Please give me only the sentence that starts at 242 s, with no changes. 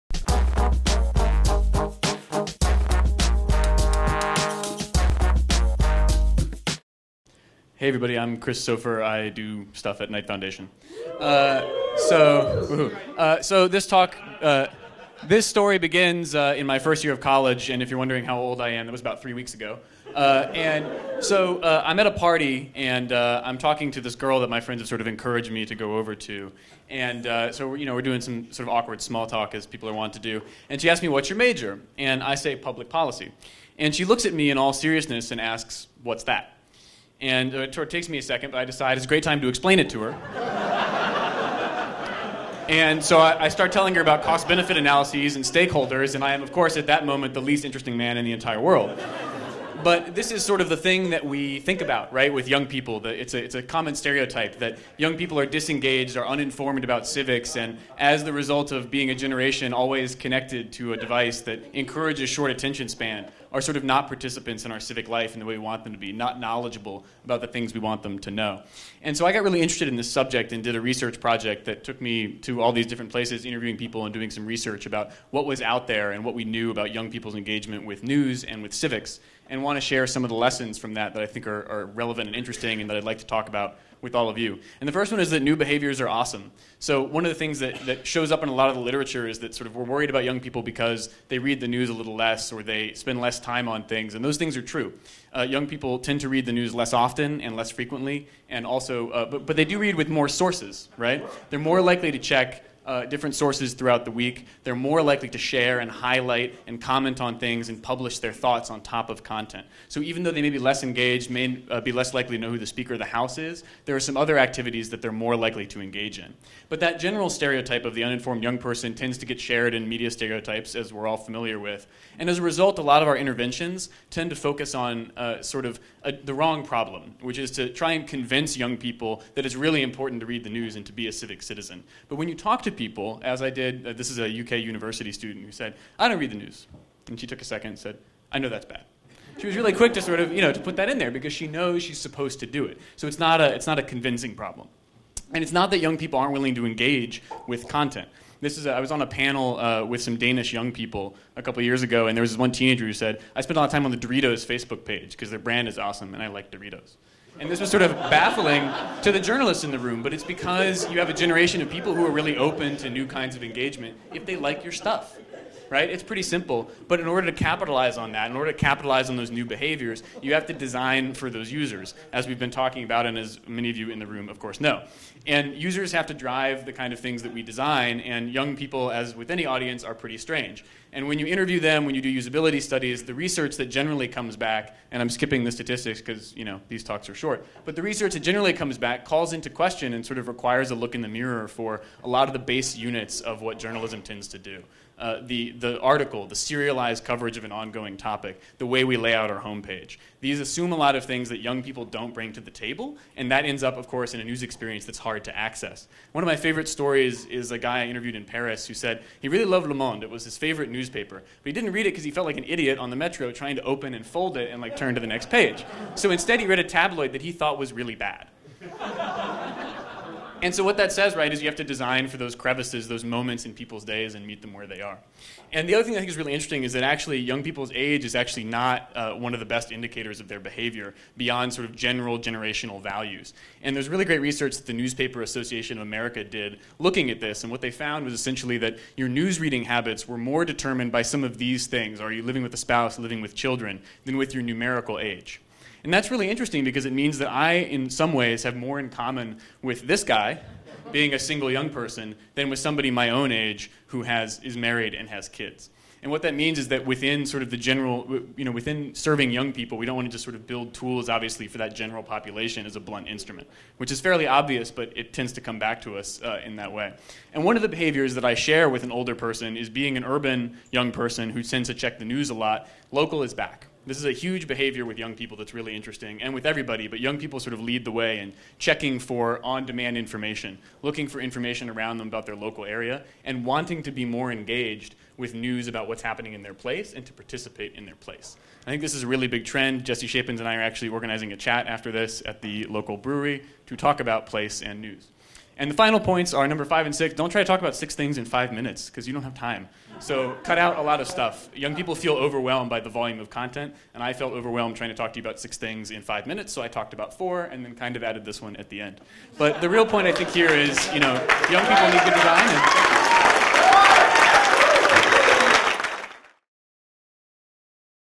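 Are you living with a spouse, living with children, than with your numerical age?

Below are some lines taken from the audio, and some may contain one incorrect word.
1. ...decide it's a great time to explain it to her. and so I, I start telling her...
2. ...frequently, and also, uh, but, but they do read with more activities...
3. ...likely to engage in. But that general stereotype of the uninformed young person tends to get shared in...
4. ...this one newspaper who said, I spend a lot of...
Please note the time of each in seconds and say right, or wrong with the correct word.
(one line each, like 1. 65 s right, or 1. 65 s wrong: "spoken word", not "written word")
1. 38 s right
2. 97 s wrong: "sources", not "activities"
3. 115 s right
4. 152 s wrong: "teenager", not "newspaper".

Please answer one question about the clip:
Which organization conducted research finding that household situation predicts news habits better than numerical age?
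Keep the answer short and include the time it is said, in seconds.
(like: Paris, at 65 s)
Newspaper Association of America, at 234 s.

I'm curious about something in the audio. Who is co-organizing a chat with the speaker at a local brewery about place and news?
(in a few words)
Jesse Shapins.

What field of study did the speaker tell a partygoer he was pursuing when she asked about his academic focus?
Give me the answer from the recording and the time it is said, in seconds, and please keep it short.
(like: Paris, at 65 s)
Public policy, at 32 s.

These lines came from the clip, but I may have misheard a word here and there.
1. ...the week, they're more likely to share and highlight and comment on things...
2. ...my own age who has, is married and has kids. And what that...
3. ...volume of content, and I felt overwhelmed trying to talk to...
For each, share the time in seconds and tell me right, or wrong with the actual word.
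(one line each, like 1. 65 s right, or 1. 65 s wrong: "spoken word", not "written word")
1. 104 s right
2. 252 s right
3. 302 s right.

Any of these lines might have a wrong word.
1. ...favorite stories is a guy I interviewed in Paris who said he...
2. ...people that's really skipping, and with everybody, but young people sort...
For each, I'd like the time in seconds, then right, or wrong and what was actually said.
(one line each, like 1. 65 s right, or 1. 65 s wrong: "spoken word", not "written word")
1. 206 s right
2. 275 s wrong: "interesting", not "skipping".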